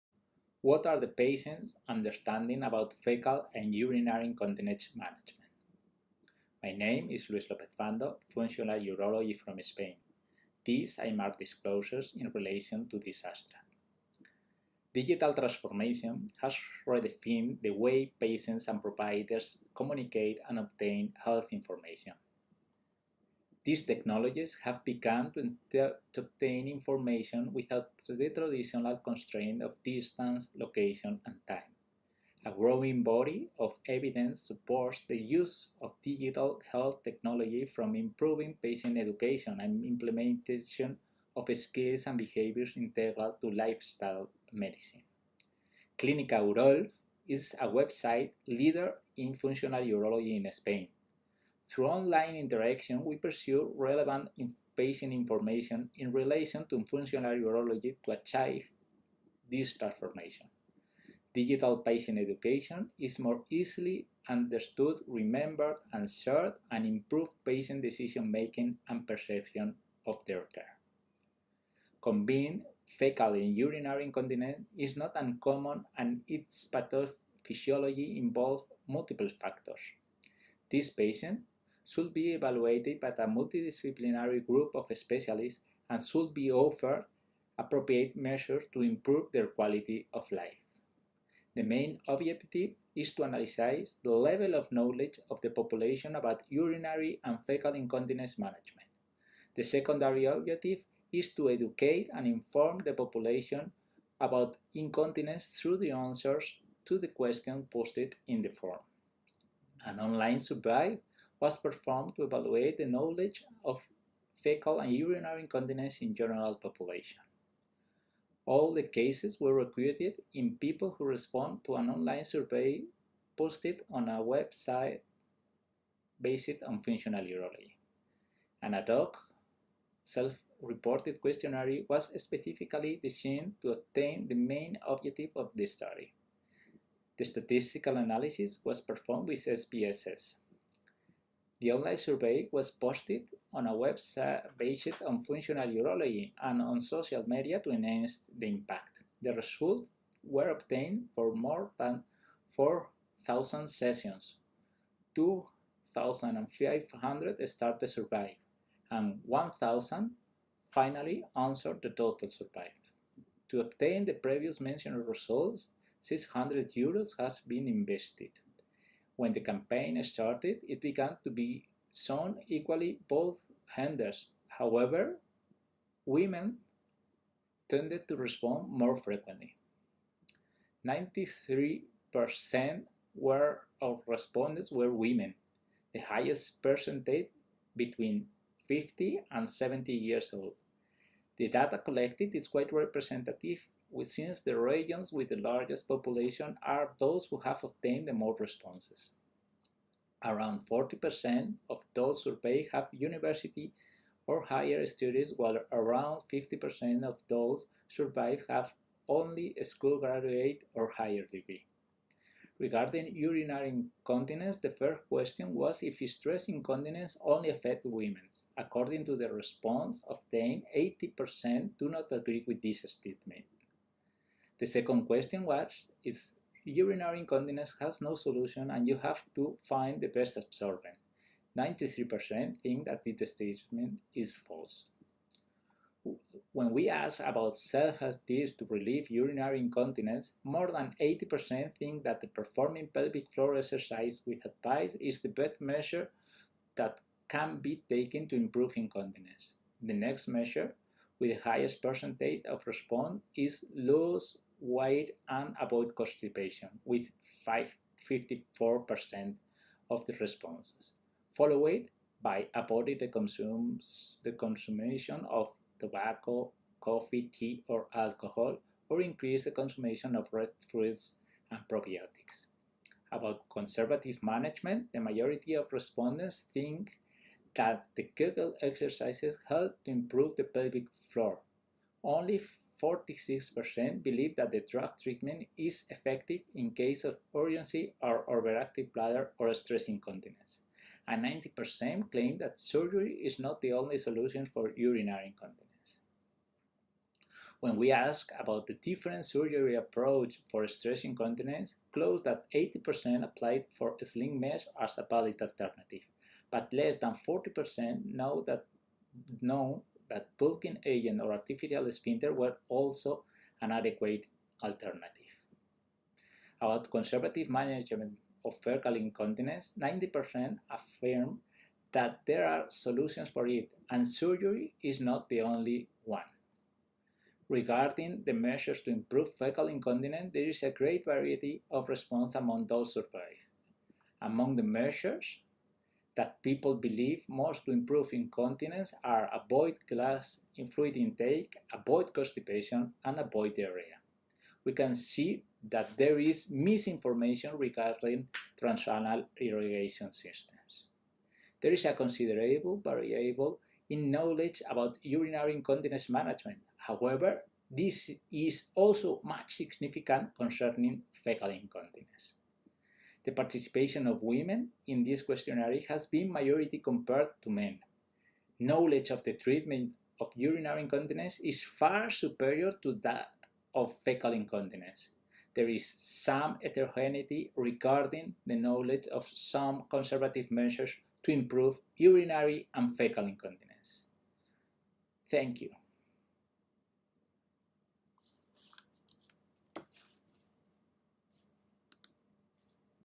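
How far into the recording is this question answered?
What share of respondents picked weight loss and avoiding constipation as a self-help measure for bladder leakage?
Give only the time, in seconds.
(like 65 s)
257 s.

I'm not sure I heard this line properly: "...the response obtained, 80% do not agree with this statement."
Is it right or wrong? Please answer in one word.
right.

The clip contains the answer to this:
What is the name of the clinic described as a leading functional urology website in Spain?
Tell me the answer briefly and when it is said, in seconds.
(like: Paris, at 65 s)
Clínica UROLF, at 45 s.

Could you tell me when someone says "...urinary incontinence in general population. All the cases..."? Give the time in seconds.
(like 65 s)
114 s.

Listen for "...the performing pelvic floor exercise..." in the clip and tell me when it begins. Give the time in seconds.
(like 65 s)
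242 s.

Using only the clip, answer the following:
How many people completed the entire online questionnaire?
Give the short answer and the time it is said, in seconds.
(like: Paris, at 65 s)
1,000, at 159 s.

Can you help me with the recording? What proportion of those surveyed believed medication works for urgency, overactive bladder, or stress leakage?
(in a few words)
46%.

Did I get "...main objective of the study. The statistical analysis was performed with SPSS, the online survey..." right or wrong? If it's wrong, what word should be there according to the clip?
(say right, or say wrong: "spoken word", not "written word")
right.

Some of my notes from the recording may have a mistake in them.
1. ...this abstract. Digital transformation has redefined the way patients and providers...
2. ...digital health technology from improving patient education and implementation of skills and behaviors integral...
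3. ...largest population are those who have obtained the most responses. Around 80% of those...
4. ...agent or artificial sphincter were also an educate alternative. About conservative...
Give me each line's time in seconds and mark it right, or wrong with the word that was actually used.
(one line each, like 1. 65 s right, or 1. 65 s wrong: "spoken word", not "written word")
1. 12 s right
2. 36 s right
3. 195 s wrong: "40", not "80"
4. 310 s wrong: "adequate", not "educate".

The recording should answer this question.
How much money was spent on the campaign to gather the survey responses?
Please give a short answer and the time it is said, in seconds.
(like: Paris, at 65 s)
600 euros, at 165 s.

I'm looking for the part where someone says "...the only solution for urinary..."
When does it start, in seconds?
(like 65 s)
293 s.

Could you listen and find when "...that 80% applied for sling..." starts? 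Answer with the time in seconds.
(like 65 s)
302 s.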